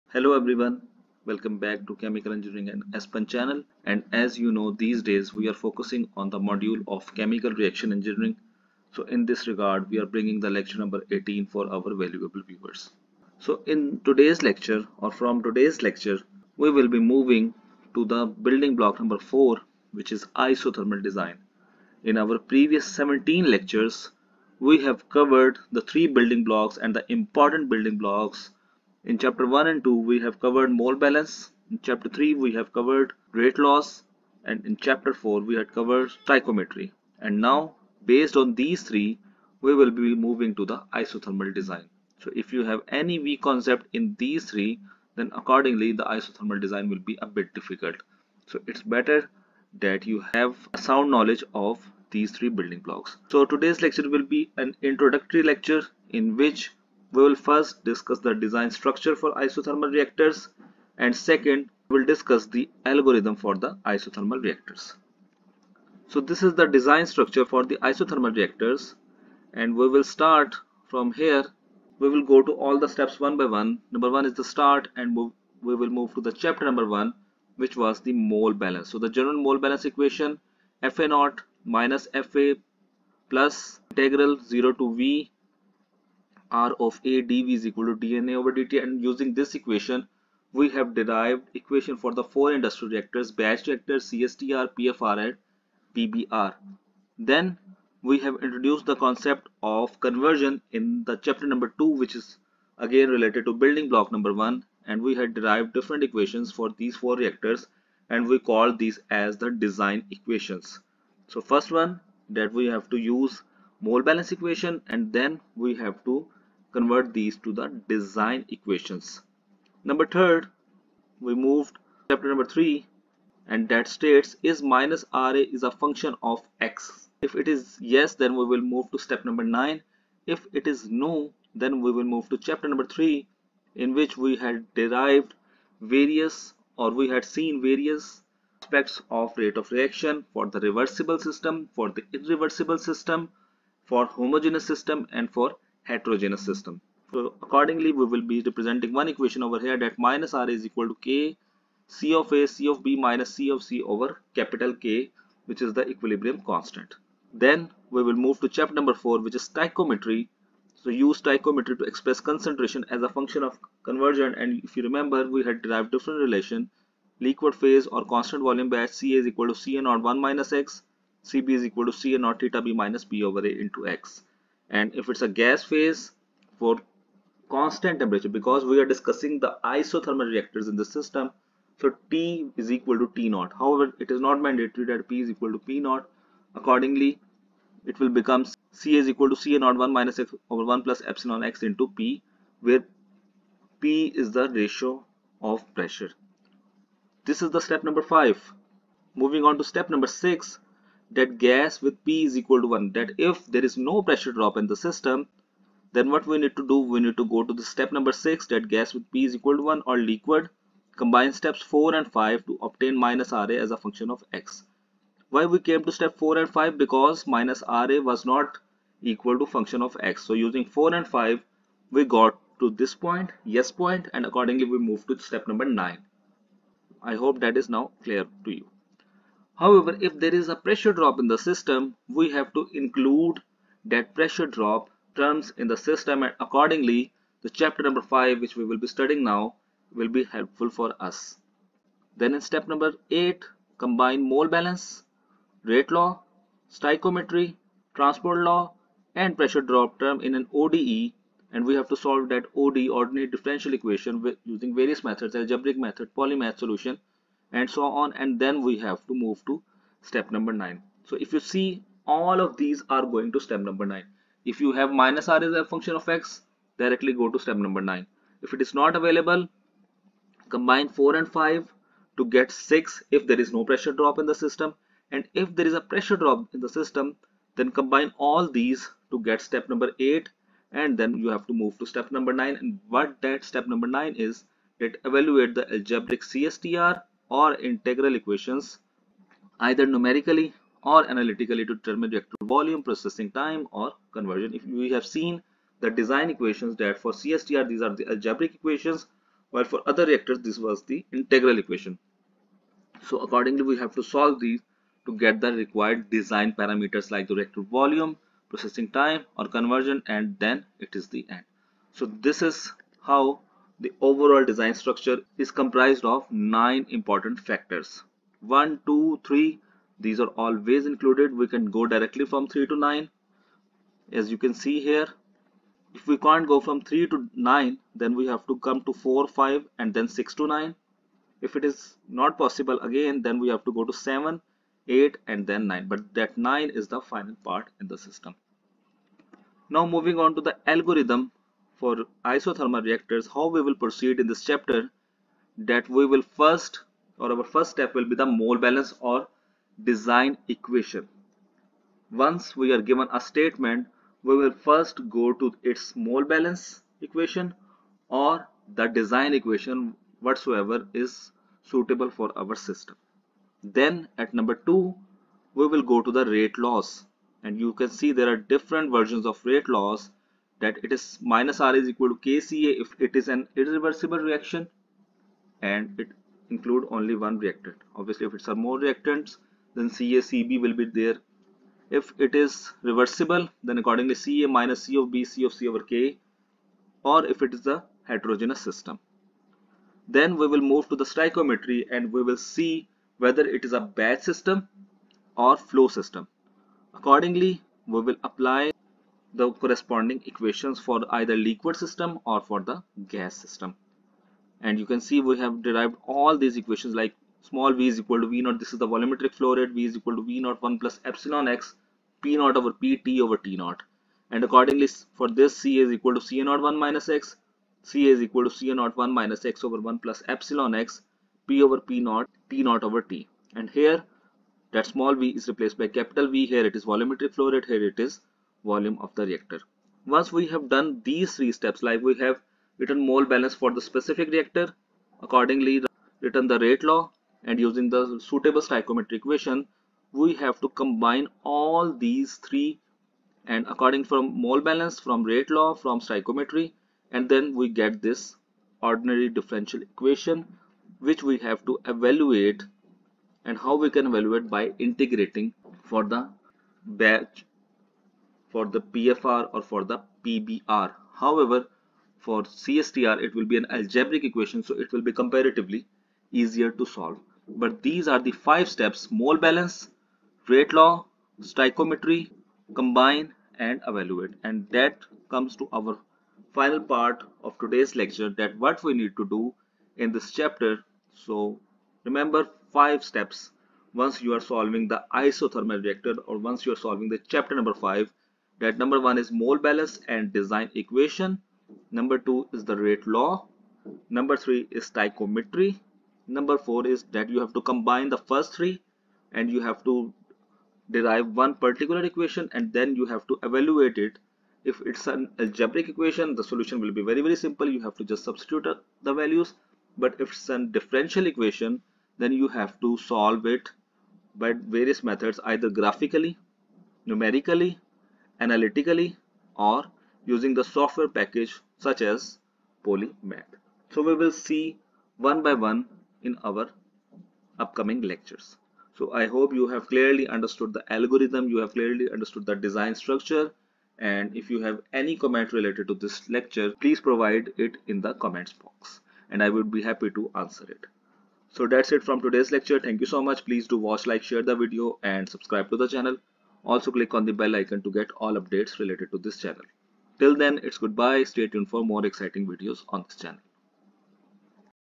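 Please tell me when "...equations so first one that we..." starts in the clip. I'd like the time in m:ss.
1:50.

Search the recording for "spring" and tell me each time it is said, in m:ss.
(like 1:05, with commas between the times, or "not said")
not said.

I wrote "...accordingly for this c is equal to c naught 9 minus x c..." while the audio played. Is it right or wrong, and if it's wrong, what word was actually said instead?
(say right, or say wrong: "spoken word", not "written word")
wrong: "1", not "9".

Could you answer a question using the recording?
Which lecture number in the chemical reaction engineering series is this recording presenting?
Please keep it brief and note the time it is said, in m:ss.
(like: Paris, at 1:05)
18, at 0:10.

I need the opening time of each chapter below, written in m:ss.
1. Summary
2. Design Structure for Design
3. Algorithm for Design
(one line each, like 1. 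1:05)
1. 7:55
2. 1:06
3. 5:39.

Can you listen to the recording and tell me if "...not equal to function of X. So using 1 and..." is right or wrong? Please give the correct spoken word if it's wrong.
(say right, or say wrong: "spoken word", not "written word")
wrong: "4", not "1".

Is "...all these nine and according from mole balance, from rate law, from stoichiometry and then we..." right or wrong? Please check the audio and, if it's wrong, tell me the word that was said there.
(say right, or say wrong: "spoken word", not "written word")
wrong: "three", not "nine".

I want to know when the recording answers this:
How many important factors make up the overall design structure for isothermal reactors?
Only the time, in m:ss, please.
5:16.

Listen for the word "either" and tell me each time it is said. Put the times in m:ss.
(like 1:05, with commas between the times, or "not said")
4:49, 6:41, 8:35.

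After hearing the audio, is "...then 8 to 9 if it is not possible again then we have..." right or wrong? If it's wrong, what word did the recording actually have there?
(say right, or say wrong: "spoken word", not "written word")
wrong: "6", not "8".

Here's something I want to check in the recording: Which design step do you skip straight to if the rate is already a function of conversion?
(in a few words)
Step 9.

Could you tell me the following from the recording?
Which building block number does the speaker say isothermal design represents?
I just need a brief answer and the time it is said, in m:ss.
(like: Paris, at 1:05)
4, at 0:18.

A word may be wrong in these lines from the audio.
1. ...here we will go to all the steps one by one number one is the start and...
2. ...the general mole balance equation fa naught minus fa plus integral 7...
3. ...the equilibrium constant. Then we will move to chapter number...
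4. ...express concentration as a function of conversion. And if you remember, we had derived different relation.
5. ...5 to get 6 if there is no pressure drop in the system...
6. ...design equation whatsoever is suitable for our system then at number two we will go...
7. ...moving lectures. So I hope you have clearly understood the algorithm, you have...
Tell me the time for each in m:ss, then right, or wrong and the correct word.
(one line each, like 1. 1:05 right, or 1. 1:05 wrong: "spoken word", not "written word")
1. 1:11 right
2. 1:18 wrong: "0", not "7"
3. 2:35 right
4. 2:41 right
5. 4:31 right
6. 5:58 right
7. 8:47 wrong: "upcoming", not "moving".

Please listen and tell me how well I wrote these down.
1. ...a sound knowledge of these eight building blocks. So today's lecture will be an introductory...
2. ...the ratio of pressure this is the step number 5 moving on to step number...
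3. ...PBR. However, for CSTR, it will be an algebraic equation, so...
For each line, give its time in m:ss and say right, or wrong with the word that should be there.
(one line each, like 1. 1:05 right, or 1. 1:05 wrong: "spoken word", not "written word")
1. 0:50 wrong: "three", not "eight"
2. 3:14 right
3. 7:40 right.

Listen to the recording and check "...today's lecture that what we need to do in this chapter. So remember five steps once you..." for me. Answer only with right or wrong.
right.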